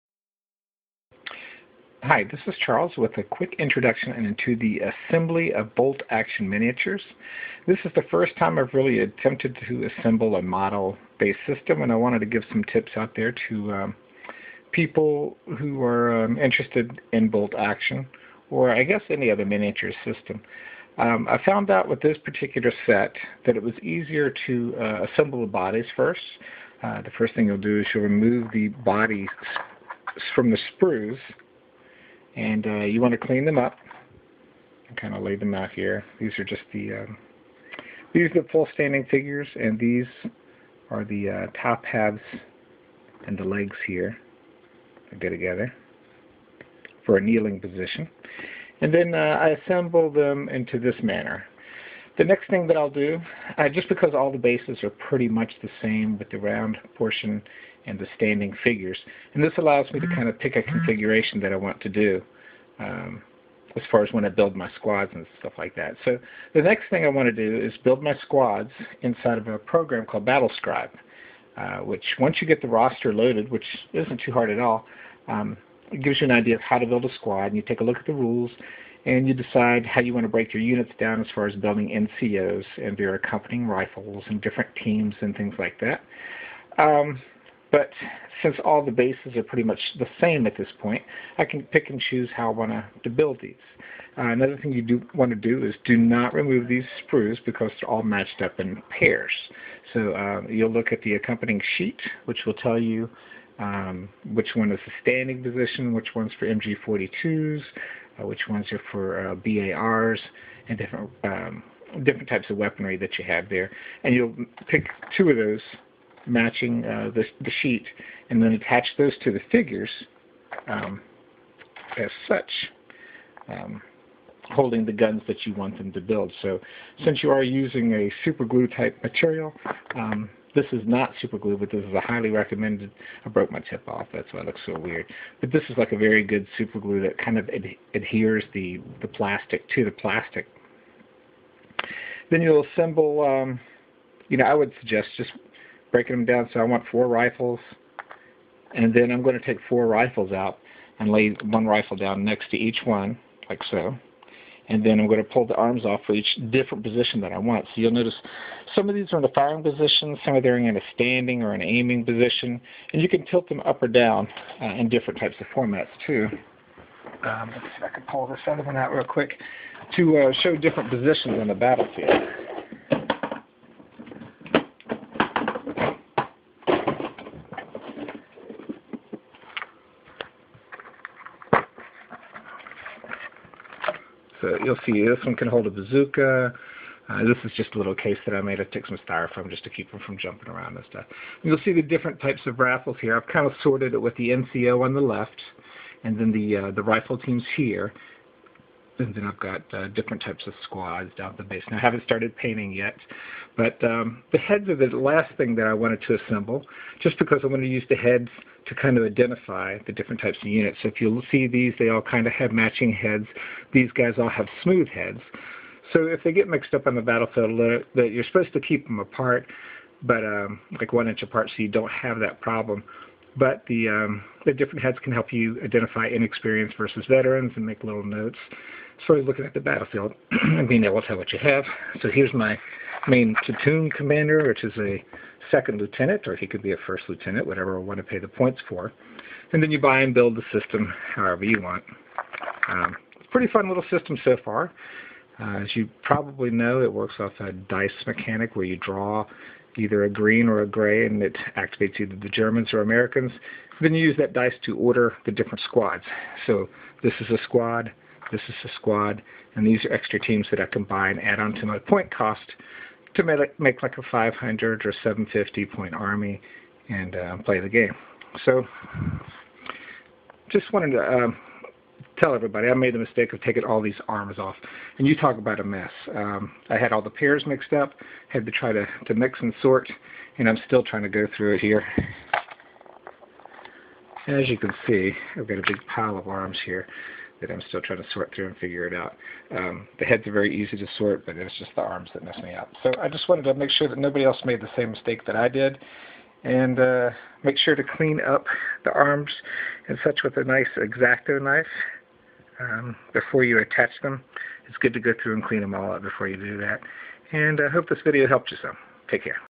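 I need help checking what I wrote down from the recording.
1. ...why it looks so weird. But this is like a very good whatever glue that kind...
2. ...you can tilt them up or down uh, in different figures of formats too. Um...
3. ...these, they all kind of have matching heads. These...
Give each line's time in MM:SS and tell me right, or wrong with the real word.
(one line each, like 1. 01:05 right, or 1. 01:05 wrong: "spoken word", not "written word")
1. 02:14 wrong: "super", not "whatever"
2. 02:43 wrong: "types", not "figures"
3. 03:31 right.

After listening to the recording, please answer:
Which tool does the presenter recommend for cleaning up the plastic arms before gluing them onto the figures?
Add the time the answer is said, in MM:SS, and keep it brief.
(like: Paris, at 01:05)
X-Acto knife, at 05:00.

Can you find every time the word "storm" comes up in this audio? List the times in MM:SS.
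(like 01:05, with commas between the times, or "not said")
not said.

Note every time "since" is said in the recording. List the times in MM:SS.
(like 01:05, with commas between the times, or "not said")
01:28, 02:07.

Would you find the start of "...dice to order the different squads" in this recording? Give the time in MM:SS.
04:14.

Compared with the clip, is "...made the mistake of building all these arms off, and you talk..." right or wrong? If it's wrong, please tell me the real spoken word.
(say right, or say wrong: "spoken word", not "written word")
wrong: "taking", not "building".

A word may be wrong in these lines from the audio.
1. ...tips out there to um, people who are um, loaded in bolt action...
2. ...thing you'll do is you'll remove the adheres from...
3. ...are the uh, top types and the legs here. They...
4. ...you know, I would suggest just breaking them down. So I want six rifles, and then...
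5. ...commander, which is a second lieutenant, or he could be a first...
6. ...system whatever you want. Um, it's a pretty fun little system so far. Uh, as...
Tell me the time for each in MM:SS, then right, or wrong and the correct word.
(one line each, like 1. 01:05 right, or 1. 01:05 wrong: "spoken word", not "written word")
1. 00:12 wrong: "interested", not "loaded"
2. 00:27 wrong: "bodies", not "adheres"
3. 00:40 wrong: "halves", not "types"
4. 02:24 wrong: "four", not "six"
5. 03:53 right
6. 04:00 wrong: "however", not "whatever".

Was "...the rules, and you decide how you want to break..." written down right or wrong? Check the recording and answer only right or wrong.
right.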